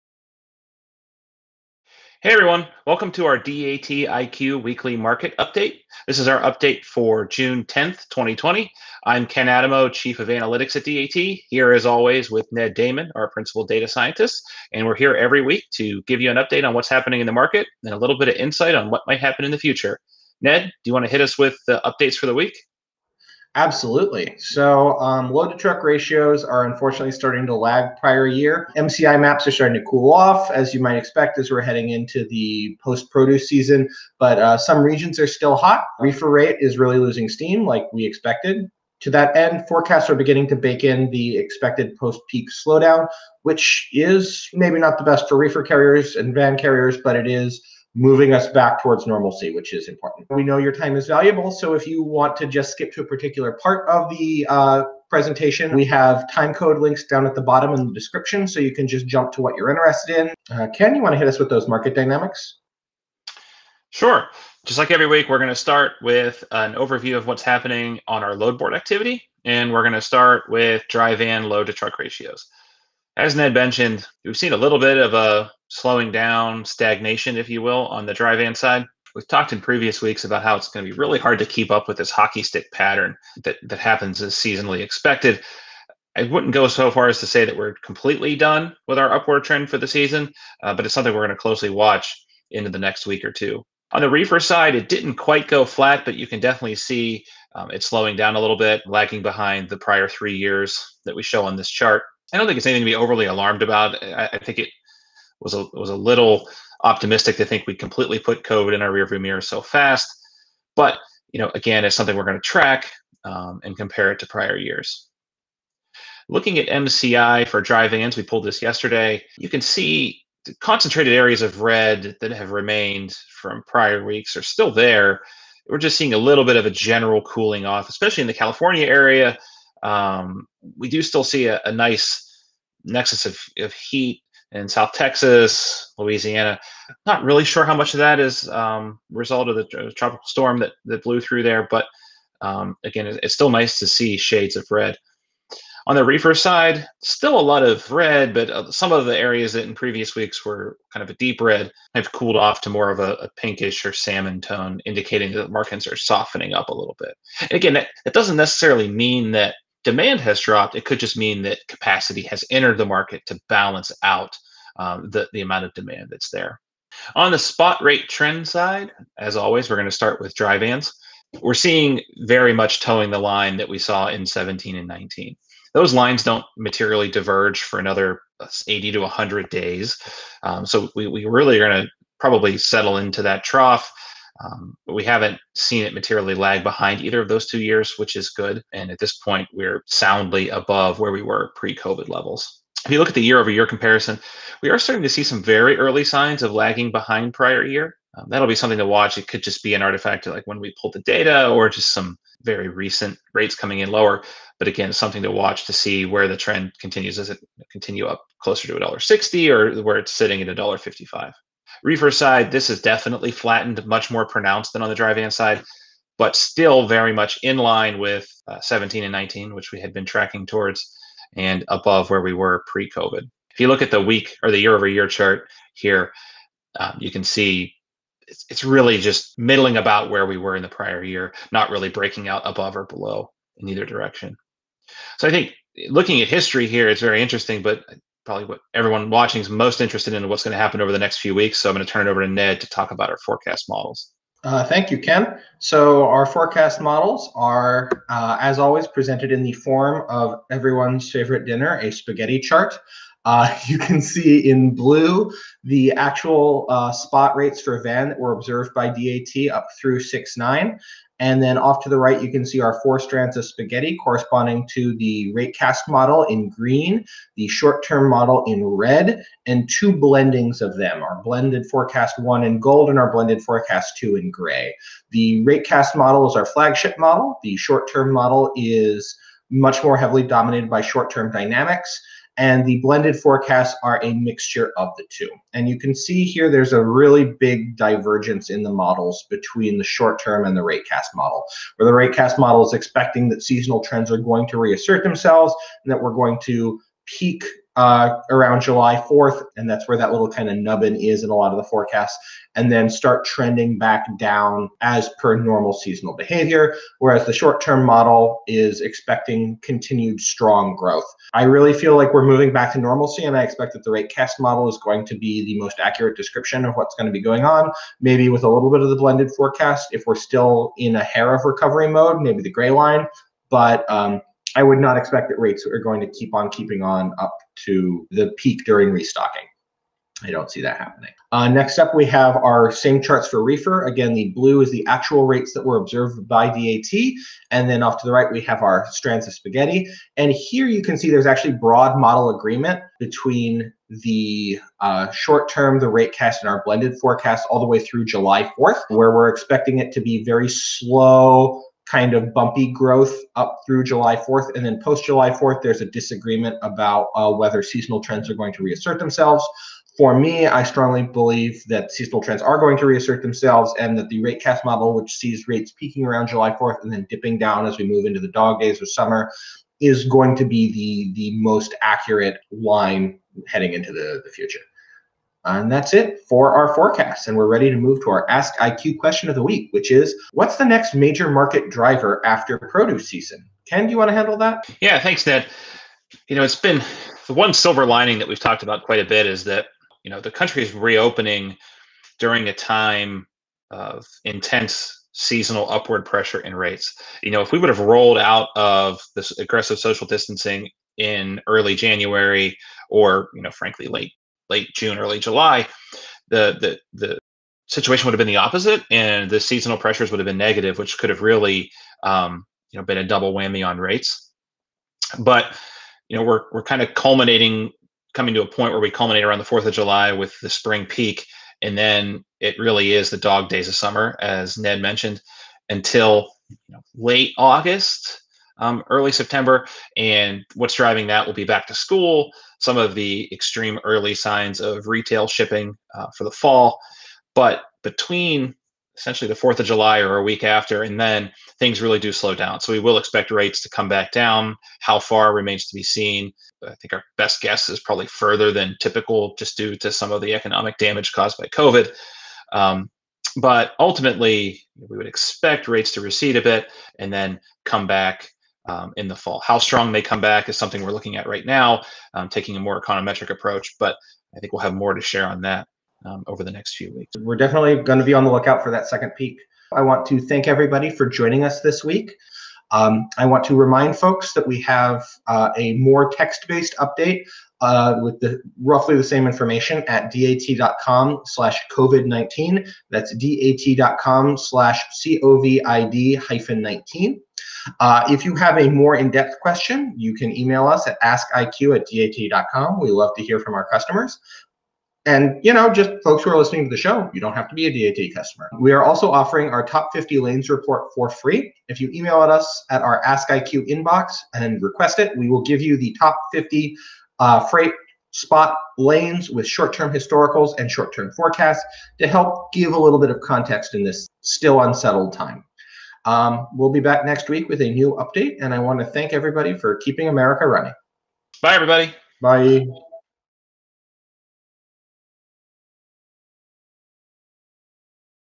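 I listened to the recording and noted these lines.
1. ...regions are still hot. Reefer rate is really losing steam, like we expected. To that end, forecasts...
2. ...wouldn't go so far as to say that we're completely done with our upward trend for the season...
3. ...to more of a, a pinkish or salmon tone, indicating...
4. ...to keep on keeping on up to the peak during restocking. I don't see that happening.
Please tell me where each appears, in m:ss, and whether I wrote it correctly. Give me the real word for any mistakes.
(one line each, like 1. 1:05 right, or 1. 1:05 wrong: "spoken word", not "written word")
1. 0:34 right
2. 1:26 right
3. 2:32 right
4. 5:26 right.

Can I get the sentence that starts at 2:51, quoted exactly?
We're seeing very much toeing the line that we saw in 17 and 19.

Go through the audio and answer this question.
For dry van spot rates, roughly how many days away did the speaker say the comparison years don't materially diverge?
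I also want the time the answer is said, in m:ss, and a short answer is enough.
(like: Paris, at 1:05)
80 to 100 days, at 2:58.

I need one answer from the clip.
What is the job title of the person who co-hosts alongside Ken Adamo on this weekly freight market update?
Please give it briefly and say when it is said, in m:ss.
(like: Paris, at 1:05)
Principal Data Scientist, at 0:13.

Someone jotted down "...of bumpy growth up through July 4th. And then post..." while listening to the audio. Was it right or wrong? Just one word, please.
right.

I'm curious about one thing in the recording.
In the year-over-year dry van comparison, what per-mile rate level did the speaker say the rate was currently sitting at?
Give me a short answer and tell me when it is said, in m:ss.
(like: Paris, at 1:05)
$1.55, at 3:30.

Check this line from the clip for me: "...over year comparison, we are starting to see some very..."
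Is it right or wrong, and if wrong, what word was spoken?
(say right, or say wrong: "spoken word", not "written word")
right.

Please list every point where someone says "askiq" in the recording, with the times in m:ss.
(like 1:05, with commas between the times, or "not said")
8:11, 8:23.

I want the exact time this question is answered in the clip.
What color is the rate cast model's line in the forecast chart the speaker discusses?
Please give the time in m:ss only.
4:26.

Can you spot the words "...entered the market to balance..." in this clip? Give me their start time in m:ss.
2:42.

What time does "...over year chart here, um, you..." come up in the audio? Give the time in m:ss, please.
3:44.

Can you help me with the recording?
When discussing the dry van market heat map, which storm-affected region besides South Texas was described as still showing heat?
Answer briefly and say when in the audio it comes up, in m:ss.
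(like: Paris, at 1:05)
Louisiana, at 2:15.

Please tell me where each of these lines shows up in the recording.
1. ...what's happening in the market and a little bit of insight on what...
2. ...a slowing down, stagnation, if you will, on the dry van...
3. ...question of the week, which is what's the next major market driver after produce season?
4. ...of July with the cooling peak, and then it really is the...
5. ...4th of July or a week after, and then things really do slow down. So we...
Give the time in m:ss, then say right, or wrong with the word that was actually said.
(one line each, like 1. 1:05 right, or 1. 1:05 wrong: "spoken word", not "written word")
1. 0:16 right
2. 1:15 right
3. 6:18 right
4. 6:59 wrong: "spring", not "cooling"
5. 7:19 right.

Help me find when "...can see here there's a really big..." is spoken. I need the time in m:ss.
4:45.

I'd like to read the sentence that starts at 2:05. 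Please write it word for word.
We're just seeing a little bit of a general cooling off, especially in the California area.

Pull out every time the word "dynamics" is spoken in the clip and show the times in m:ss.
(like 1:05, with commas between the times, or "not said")
1:01, 4:41.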